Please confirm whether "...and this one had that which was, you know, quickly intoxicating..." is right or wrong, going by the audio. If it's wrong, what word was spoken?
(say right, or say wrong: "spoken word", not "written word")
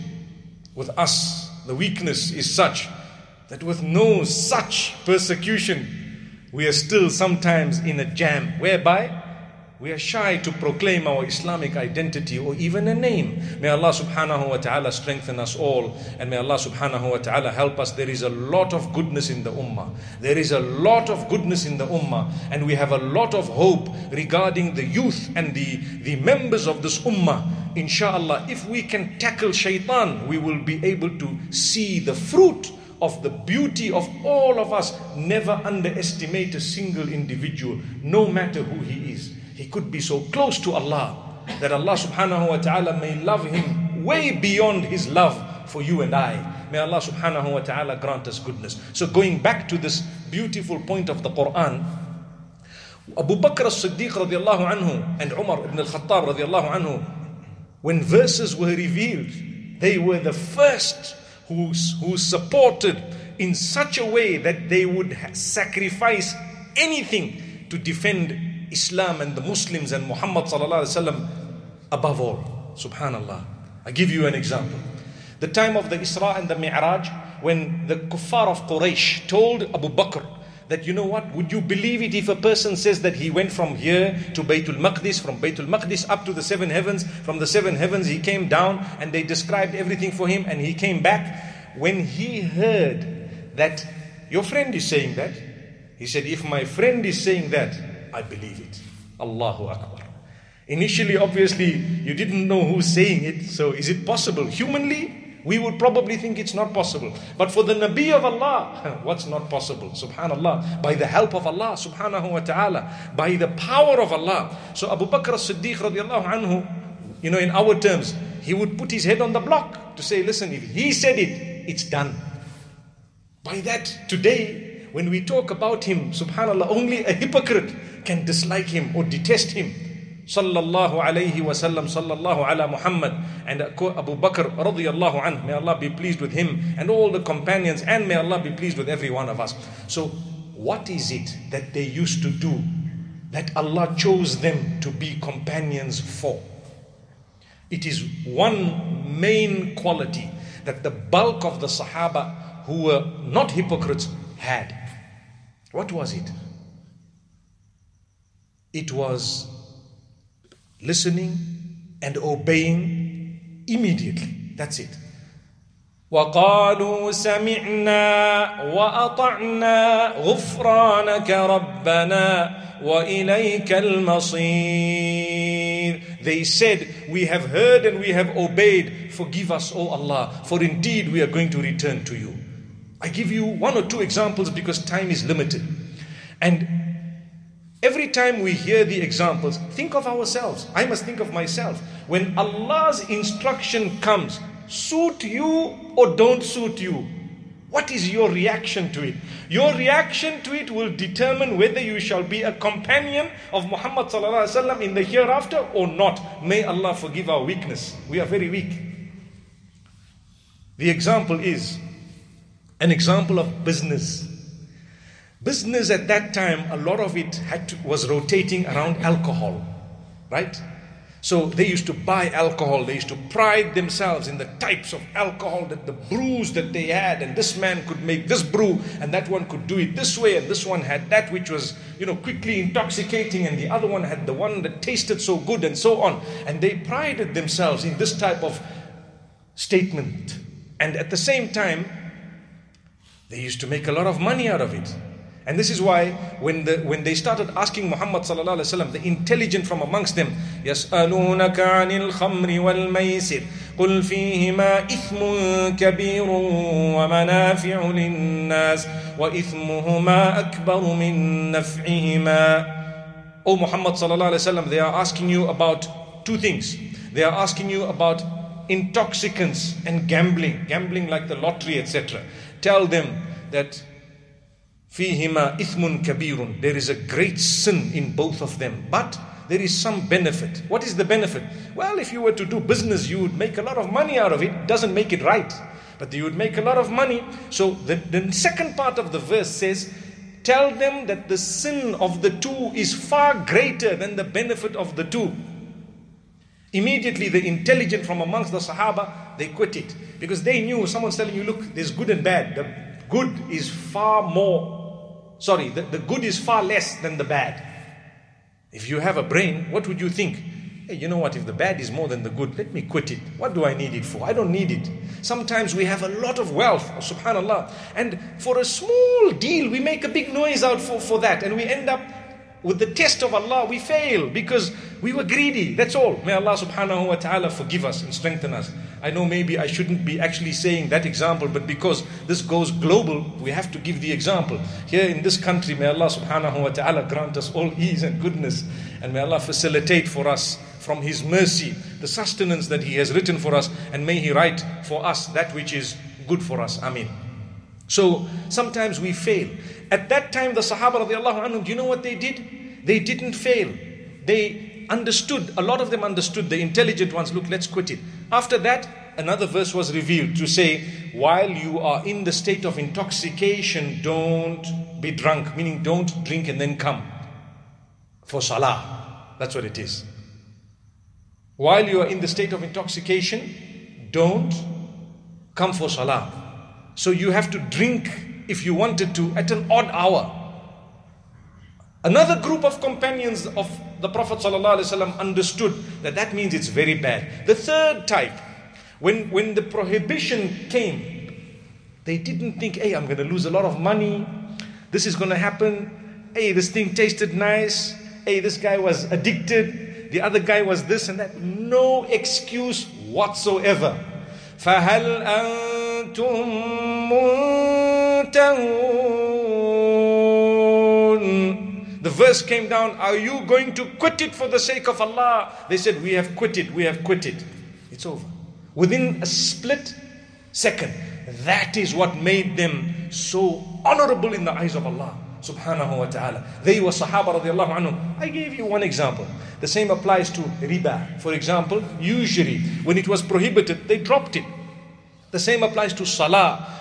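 right.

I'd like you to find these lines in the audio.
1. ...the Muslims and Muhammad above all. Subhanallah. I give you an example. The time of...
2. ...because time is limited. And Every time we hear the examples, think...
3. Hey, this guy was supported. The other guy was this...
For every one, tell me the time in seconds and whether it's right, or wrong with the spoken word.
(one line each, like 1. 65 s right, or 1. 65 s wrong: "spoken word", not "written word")
1. 69 s right
2. 184 s right
3. 398 s wrong: "addicted", not "supported".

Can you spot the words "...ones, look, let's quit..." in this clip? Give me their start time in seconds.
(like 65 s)
357 s.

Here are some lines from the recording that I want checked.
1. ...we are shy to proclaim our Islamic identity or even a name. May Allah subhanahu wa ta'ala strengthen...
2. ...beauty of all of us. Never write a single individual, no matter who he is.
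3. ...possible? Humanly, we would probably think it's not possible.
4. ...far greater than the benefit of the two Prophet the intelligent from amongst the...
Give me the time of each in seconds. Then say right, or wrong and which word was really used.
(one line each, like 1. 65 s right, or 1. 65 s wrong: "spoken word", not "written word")
1. 9 s right
2. 33 s wrong: "underestimate", not "write"
3. 104 s right
4. 292 s wrong: "Immediately", not "Prophet".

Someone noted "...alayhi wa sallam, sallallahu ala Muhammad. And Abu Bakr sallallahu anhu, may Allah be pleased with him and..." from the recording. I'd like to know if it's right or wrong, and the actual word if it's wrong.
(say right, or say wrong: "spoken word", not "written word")
wrong: "radiallahu", not "sallallahu".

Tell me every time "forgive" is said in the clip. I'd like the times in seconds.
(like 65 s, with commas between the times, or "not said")
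179 s, 206 s, 327 s.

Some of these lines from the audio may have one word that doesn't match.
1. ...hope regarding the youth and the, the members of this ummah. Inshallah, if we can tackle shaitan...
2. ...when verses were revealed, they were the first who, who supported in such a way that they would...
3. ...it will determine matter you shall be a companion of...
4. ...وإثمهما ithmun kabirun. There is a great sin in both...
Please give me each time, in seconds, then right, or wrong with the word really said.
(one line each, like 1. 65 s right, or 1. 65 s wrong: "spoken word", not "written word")
1. 23 s right
2. 57 s right
3. 200 s wrong: "whether", not "matter"
4. 274 s wrong: "فيهما", not "وإثمهما".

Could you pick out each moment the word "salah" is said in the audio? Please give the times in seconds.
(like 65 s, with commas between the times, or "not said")
368 s, 375 s, 436 s.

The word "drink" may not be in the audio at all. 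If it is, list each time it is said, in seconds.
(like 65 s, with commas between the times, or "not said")
366 s, 377 s.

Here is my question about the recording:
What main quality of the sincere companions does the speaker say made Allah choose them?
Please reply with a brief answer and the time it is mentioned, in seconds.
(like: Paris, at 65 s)
Listening and obeying immediately, at 160 s.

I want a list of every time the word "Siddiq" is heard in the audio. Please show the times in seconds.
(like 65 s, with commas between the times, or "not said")
53 s, 115 s.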